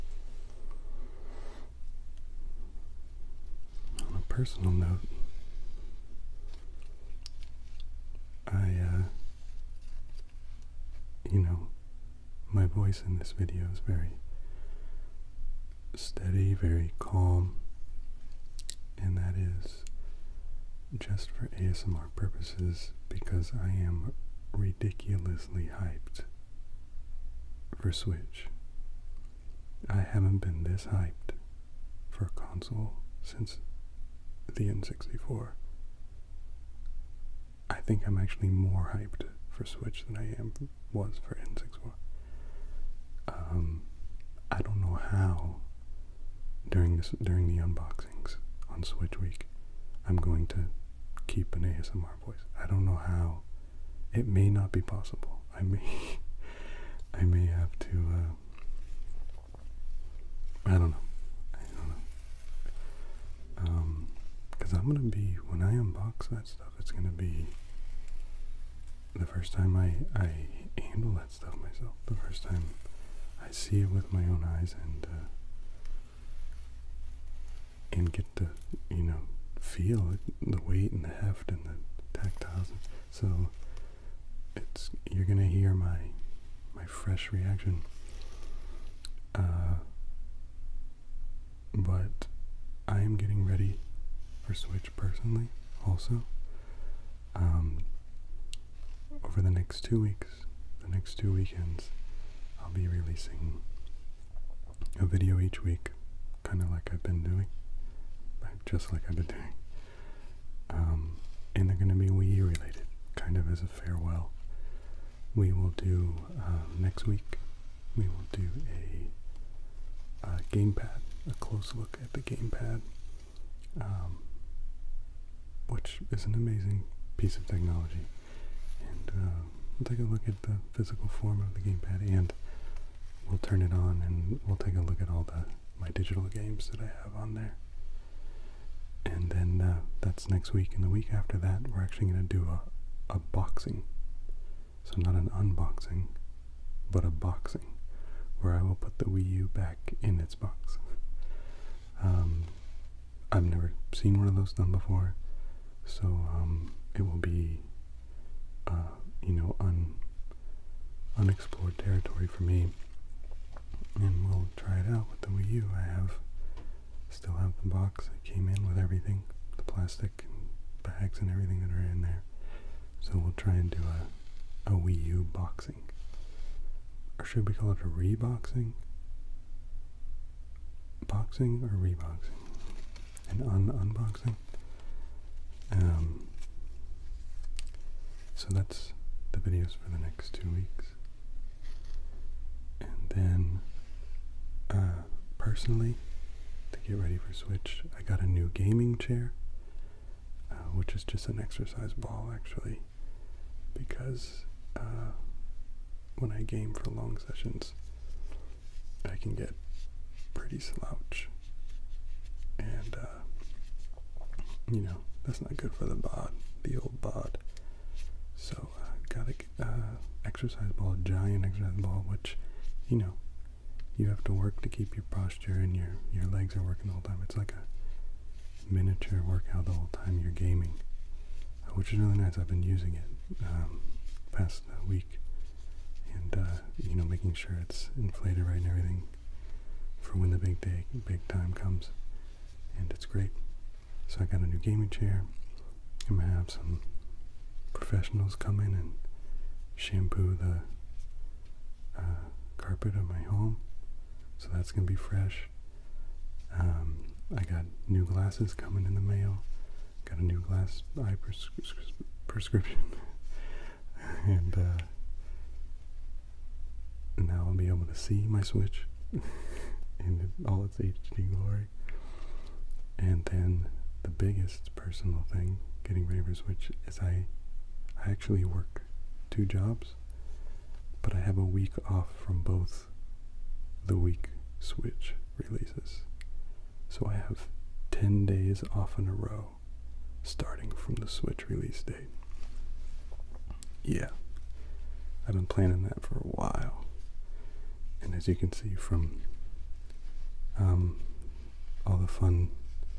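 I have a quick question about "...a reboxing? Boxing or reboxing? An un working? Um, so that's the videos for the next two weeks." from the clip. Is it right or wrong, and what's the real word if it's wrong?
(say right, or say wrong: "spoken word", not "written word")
wrong: "unboxing", not "working".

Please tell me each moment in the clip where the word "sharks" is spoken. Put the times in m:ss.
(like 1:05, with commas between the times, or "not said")
not said.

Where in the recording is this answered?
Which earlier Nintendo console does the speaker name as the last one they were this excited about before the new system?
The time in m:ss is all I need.
0:34.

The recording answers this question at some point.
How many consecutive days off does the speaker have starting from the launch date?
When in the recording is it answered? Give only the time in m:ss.
4:47.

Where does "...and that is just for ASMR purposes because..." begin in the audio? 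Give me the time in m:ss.
0:18.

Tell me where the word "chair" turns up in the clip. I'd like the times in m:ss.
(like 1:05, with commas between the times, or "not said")
3:18, 4:04.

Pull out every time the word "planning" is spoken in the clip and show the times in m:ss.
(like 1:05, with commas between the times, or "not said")
4:55.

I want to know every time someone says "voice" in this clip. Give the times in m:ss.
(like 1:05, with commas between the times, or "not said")
0:12, 0:52.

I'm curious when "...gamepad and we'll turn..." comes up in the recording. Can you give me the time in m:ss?
2:11.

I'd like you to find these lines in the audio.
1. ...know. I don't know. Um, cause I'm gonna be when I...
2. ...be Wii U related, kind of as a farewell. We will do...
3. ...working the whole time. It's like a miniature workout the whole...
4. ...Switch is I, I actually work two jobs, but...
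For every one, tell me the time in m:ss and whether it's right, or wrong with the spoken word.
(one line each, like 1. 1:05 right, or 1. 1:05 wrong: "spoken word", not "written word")
1. 1:00 right
2. 1:51 right
3. 3:46 right
4. 4:36 right.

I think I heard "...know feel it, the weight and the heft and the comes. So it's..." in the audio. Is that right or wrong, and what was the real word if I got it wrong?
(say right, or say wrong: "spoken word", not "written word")
wrong: "tactiles", not "comes".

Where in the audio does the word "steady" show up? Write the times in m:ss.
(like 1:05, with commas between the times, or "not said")
0:15.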